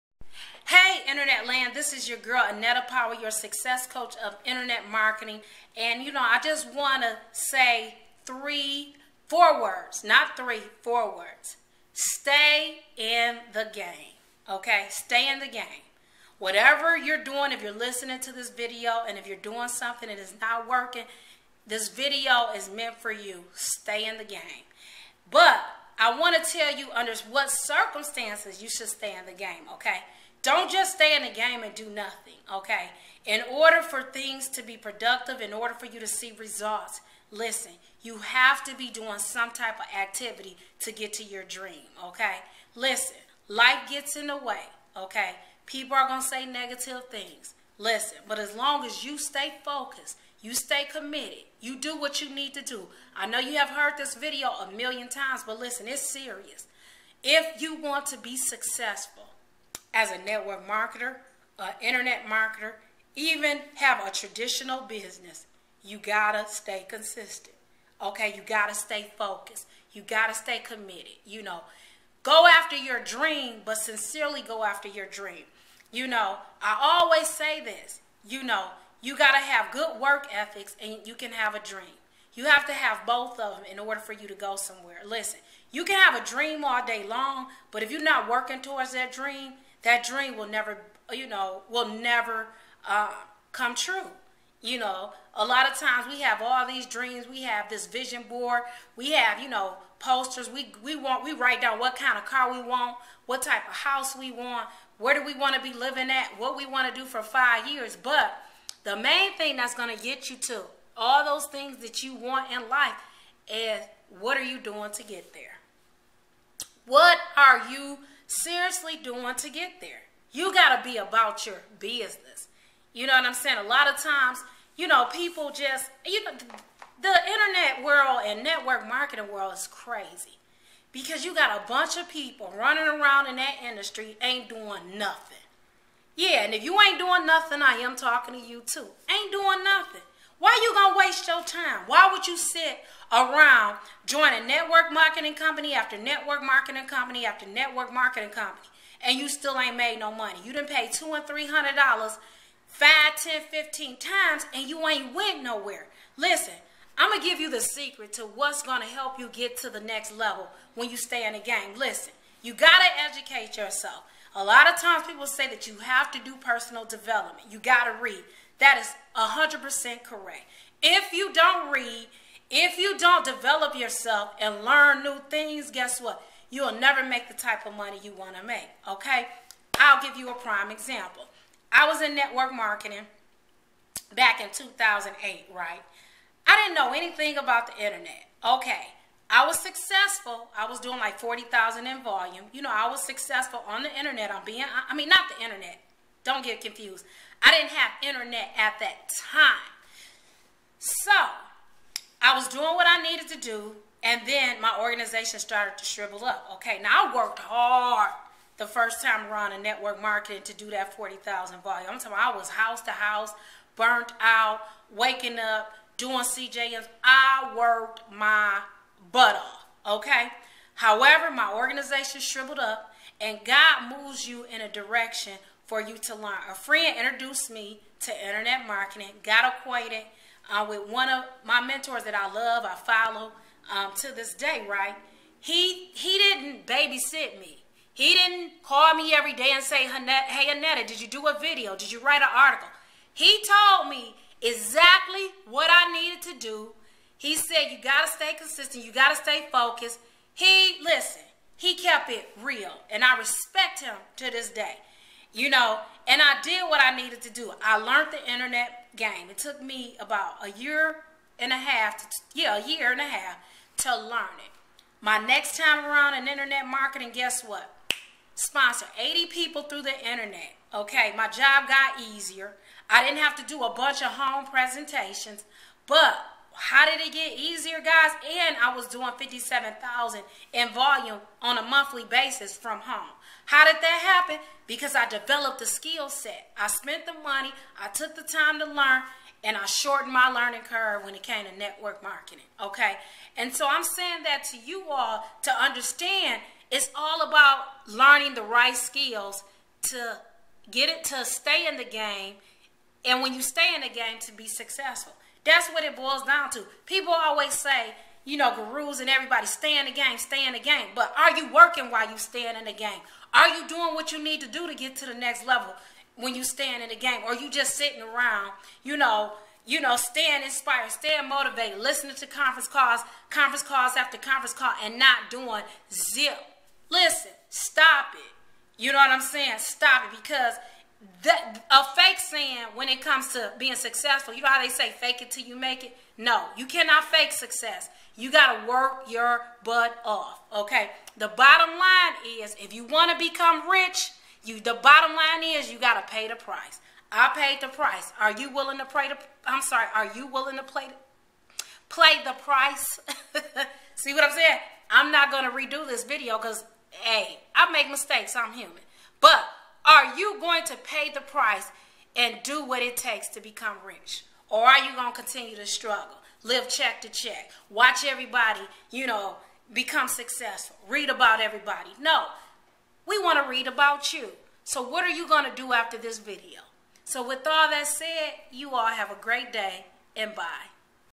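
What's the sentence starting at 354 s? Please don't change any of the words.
I'm not going to redo this video cuz hey, I make mistakes.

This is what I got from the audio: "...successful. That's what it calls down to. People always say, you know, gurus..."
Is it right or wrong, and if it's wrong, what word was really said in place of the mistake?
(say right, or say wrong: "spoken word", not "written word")
wrong: "boils", not "calls".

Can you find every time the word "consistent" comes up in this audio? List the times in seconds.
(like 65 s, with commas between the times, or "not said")
66 s, 248 s.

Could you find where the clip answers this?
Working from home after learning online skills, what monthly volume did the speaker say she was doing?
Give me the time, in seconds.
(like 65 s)
279 s.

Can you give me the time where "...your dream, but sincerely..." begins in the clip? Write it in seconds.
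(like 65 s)
72 s.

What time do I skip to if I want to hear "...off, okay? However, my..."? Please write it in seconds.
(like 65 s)
219 s.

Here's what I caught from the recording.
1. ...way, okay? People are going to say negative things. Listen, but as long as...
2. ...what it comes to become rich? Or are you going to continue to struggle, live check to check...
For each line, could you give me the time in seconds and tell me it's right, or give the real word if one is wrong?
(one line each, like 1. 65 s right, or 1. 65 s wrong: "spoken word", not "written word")
1. 44 s right
2. 362 s wrong: "takes", not "comes".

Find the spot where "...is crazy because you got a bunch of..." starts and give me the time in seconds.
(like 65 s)
129 s.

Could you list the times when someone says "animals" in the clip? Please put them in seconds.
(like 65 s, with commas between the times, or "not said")
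not said.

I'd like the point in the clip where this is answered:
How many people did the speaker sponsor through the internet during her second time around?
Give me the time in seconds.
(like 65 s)
268 s.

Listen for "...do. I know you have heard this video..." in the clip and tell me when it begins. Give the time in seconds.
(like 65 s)
52 s.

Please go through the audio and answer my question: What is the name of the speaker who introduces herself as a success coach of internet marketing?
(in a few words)
Annetta Powell.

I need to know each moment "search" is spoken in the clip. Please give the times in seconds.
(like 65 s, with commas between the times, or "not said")
not said.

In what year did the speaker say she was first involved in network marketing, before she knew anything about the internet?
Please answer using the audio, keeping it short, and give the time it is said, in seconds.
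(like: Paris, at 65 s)
2008, at 184 s.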